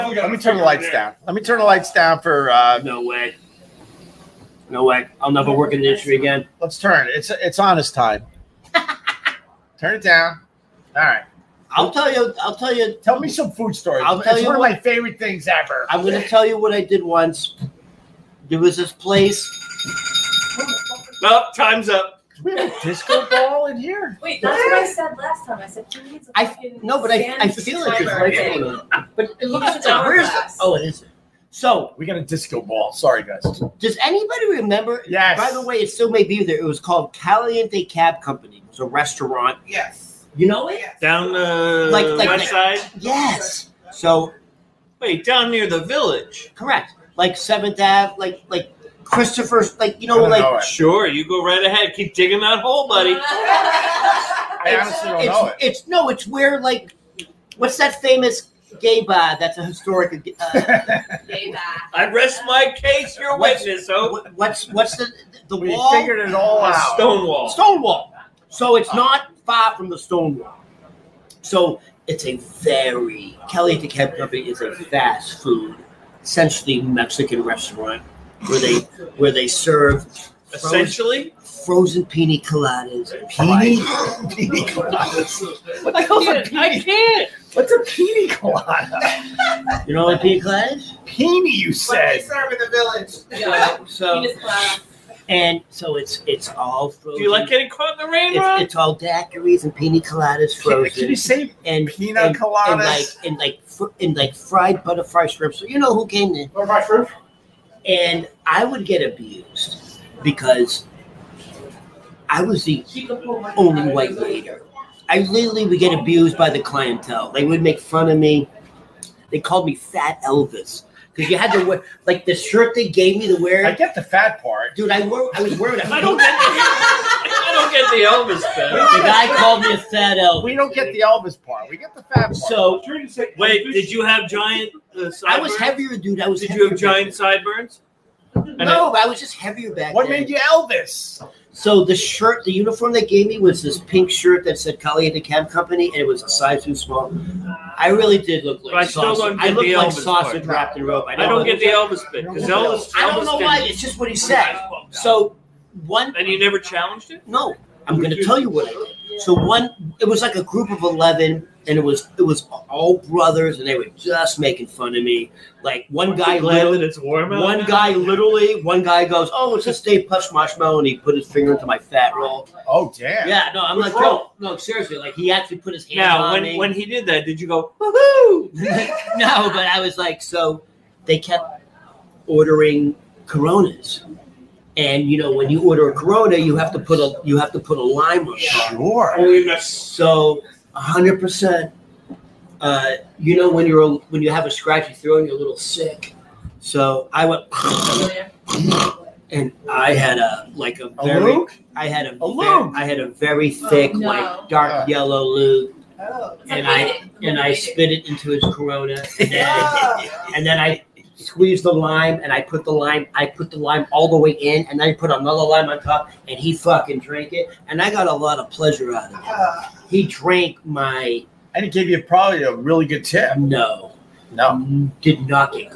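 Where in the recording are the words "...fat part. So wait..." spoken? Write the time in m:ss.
2:12.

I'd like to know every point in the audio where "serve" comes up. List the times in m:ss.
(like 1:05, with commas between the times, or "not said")
1:19, 1:32.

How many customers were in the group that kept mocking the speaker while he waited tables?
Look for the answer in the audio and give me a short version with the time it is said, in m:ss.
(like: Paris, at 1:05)
11, at 2:40.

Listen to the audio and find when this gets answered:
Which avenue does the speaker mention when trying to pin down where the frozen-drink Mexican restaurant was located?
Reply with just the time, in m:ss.
0:47.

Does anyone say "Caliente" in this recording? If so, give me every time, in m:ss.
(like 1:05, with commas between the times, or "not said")
0:37, 1:13, 2:24.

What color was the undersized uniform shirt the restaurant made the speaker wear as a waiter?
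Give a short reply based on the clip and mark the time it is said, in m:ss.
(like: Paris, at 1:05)
Pink, at 2:23.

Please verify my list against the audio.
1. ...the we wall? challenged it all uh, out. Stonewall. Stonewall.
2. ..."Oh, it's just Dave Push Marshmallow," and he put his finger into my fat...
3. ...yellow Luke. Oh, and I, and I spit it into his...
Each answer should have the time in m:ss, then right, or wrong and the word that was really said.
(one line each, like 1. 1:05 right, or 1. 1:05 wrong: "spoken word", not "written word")
1. 1:05 wrong: "figured", not "challenged"
2. 2:49 right
3. 3:24 right.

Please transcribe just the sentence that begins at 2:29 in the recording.
don't get I look the like Elvis sausage part.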